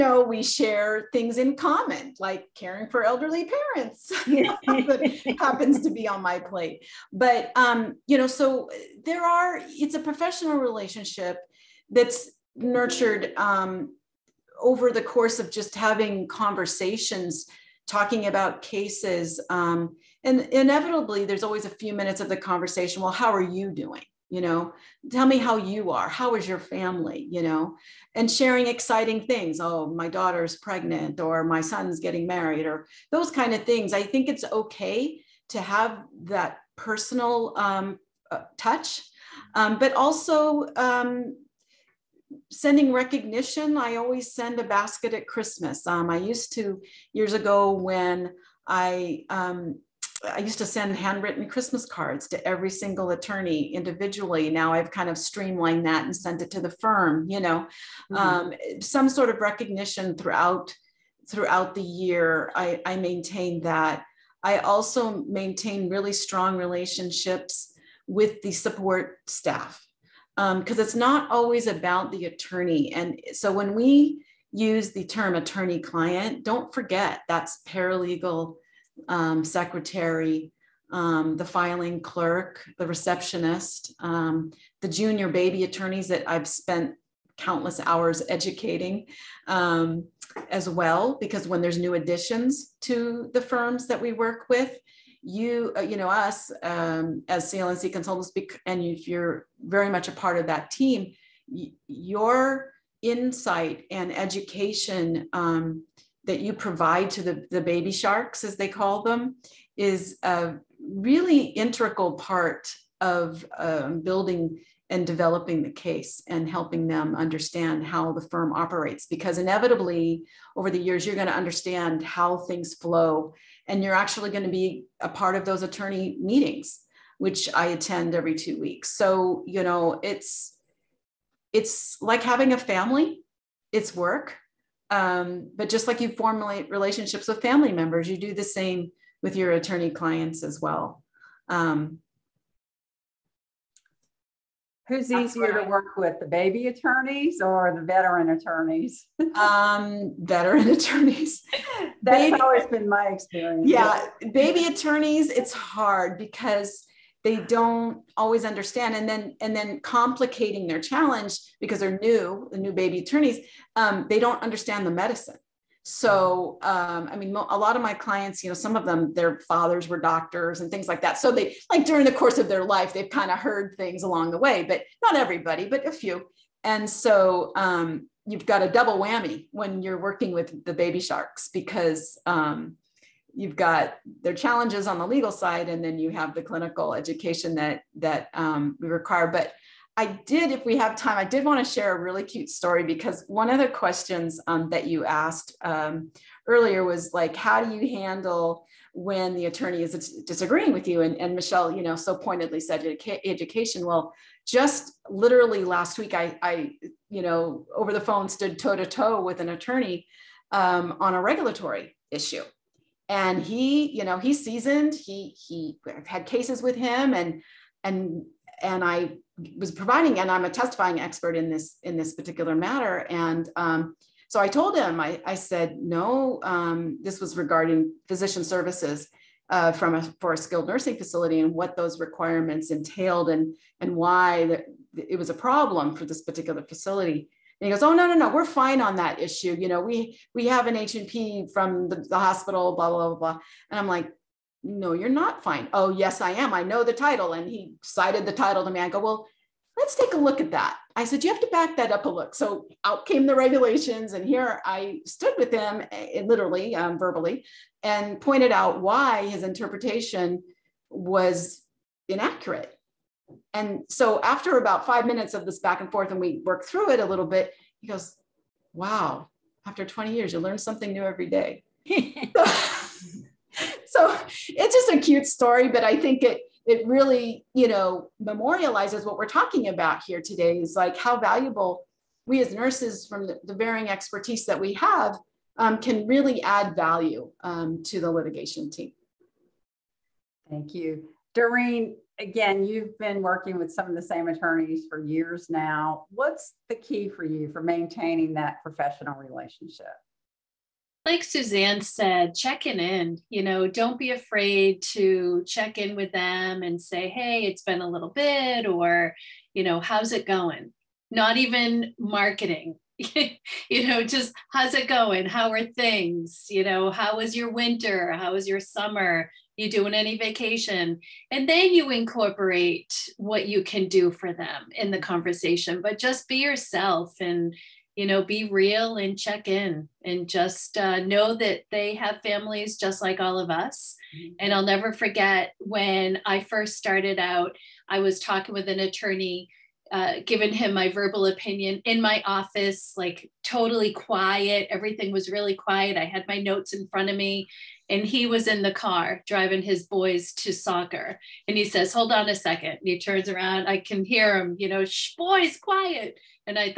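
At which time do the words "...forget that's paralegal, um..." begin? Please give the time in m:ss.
1:16.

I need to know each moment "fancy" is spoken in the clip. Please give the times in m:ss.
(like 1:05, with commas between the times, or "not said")
not said.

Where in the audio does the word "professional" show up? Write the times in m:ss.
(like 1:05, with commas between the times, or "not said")
0:09, 4:58.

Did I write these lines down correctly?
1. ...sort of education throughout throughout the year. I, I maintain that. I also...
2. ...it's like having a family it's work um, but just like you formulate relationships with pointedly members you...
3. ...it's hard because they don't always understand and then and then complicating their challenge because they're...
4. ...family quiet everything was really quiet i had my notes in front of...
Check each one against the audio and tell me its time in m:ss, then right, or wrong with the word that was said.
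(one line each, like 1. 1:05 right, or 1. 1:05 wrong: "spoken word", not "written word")
1. 0:59 wrong: "recognition", not "education"
2. 2:11 wrong: "family", not "pointedly"
3. 2:35 right
4. 5:43 wrong: "totally", not "family".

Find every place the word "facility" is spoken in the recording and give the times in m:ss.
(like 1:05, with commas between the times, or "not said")
3:50, 3:56.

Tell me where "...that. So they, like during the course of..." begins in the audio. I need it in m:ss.
2:51.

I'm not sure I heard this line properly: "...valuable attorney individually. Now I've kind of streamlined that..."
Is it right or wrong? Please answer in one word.
wrong.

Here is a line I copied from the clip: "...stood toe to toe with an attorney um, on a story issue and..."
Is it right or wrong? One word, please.
wrong.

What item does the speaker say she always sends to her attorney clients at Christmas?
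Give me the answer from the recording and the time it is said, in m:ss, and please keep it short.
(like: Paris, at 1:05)
A basket, at 0:44.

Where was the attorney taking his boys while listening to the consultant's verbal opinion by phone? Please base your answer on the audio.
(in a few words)
Soccer.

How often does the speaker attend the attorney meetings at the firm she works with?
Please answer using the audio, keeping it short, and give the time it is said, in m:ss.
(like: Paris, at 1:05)
Every two weeks, at 2:08.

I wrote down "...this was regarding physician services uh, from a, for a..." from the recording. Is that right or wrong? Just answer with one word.
right.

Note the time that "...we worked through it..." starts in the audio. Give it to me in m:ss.
4:26.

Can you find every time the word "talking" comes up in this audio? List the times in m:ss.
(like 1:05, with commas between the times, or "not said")
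0:17, 4:39, 5:38.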